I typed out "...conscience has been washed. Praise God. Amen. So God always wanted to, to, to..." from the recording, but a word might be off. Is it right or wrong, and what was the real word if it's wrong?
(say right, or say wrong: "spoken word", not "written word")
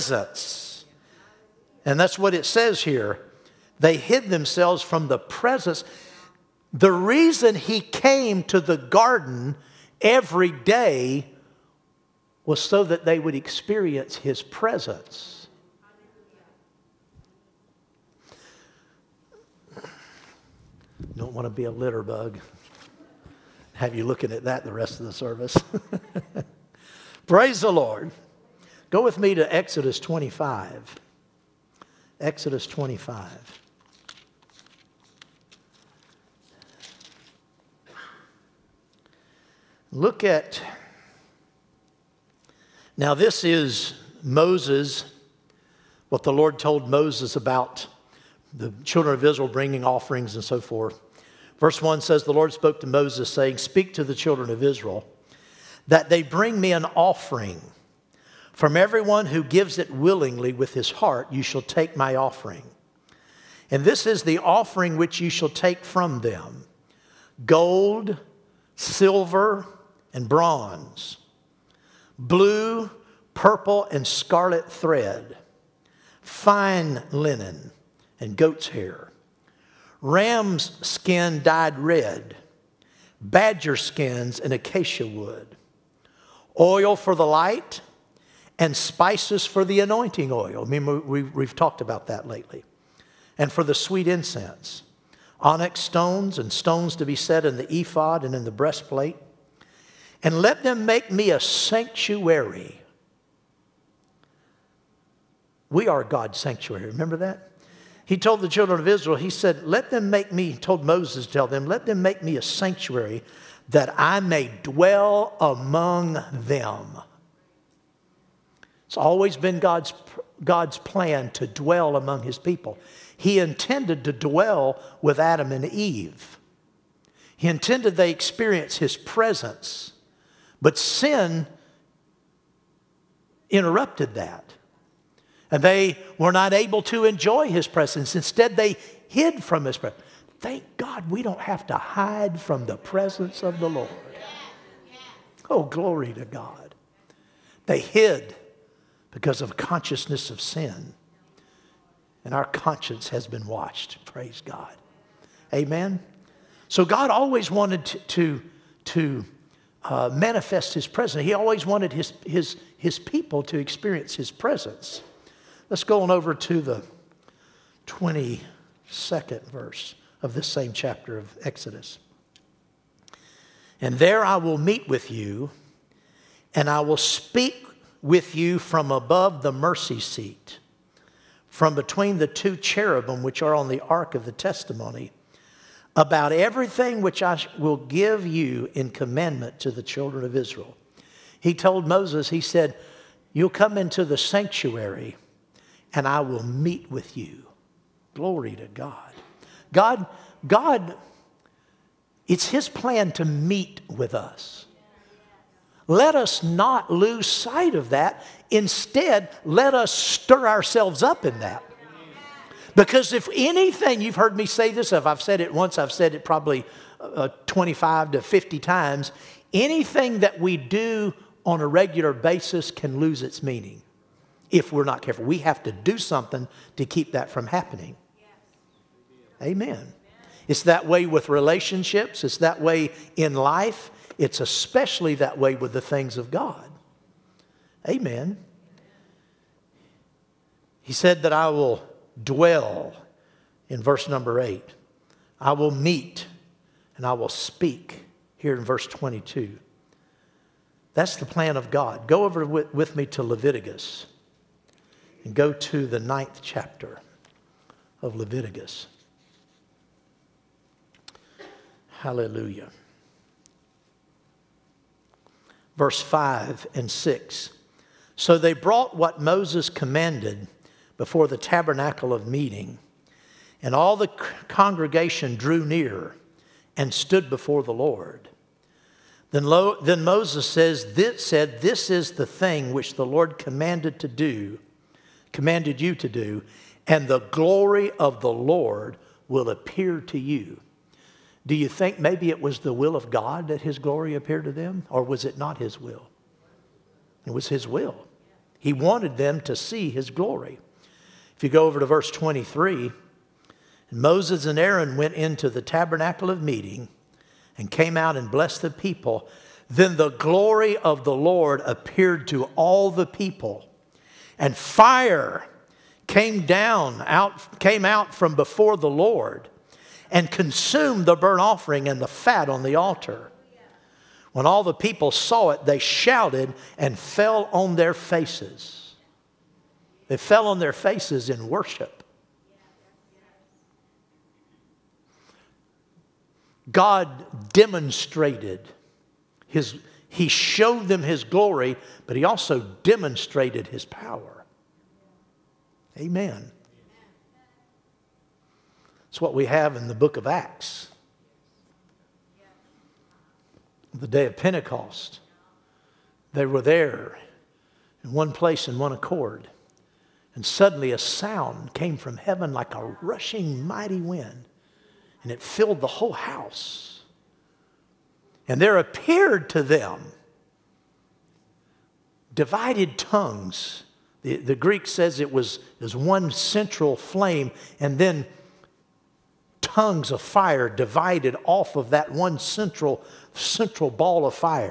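right.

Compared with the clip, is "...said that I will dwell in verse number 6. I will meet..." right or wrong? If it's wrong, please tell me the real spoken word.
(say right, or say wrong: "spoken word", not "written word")
wrong: "8", not "6".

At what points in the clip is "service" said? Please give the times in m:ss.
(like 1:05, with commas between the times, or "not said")
0:25.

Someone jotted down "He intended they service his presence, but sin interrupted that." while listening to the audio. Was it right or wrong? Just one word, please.
wrong.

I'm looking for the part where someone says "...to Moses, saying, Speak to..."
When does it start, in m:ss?
0:52.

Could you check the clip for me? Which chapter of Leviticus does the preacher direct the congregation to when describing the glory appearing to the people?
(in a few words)
Chapter 9.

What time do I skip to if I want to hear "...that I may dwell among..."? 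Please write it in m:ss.
1:53.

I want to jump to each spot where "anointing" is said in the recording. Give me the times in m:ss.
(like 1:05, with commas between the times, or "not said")
1:29.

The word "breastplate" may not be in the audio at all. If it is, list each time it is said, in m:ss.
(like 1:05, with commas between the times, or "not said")
1:38.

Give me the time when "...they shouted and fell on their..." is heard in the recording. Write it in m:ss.
5:25.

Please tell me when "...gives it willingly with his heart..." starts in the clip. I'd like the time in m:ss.
0:59.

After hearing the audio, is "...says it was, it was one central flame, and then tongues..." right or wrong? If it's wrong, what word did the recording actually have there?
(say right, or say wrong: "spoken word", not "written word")
right.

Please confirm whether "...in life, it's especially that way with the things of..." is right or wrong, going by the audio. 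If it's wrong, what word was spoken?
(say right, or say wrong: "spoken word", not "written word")
right.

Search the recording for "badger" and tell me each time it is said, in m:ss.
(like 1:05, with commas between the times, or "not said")
1:23.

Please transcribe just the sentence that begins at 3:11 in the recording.
He told Moses, He said, You'll come into the sanctuary and I will meet with you.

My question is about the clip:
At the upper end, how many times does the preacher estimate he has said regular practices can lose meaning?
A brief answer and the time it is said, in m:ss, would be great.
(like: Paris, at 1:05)
50, at 3:37.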